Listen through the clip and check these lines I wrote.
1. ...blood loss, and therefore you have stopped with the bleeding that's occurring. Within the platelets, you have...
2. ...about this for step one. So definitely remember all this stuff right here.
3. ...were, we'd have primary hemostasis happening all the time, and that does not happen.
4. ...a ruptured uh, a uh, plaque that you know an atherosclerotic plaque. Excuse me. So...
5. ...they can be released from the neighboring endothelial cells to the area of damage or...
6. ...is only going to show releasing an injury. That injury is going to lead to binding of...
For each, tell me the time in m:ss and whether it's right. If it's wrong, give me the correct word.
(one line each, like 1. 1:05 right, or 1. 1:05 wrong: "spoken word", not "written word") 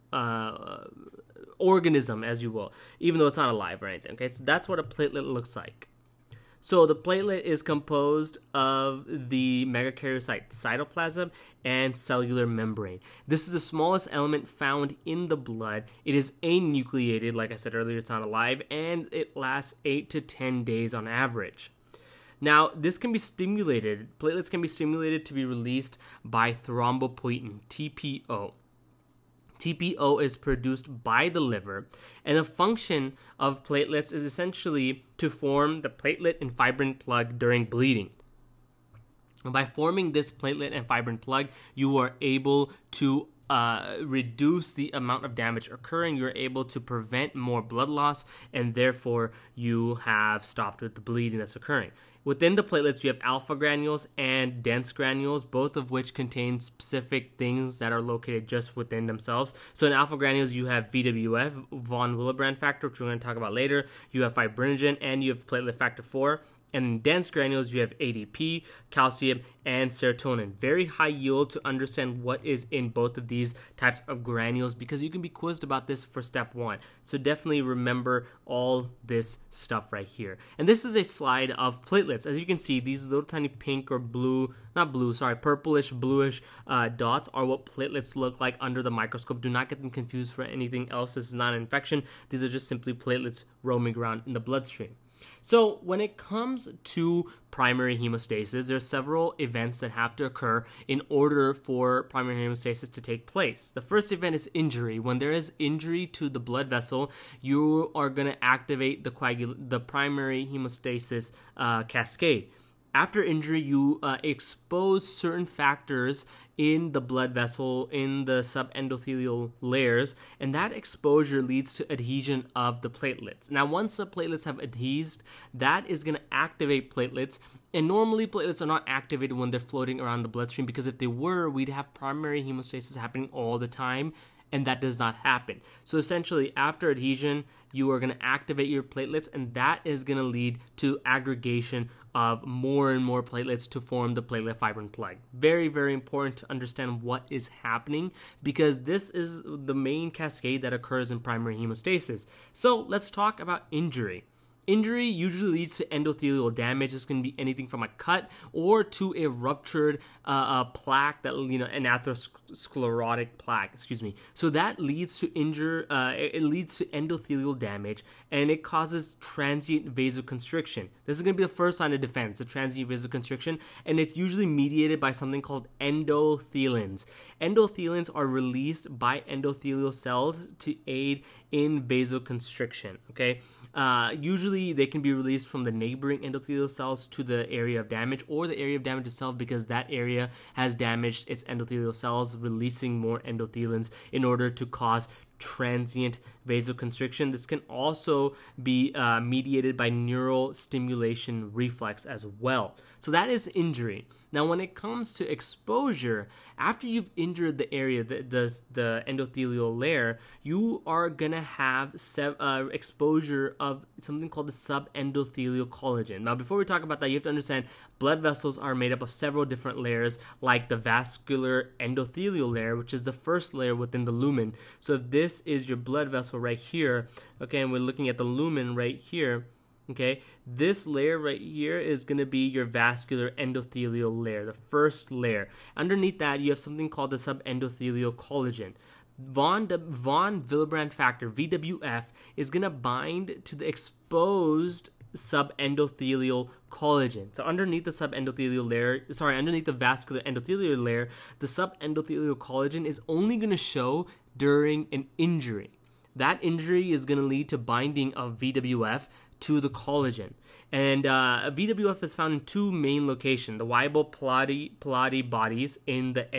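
1. 0:47 right
2. 1:15 right
3. 2:11 right
4. 2:39 right
5. 3:04 right
6. 4:12 wrong: "during", not "releasing".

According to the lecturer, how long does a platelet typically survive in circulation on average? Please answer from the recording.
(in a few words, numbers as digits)
8 to 10 days.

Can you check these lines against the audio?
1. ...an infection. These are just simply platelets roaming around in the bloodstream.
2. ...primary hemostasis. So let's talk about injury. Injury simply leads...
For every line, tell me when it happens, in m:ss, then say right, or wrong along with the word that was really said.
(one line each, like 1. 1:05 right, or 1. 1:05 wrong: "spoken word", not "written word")
1. 1:31 right
2. 2:31 wrong: "usually", not "simply".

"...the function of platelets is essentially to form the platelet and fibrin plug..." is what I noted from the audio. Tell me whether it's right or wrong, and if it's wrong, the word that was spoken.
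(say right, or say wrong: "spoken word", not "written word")
right.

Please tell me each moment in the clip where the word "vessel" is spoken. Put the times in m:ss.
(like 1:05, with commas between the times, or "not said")
1:46, 1:57, 3:38, 3:46.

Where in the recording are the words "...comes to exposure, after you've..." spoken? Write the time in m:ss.
3:24.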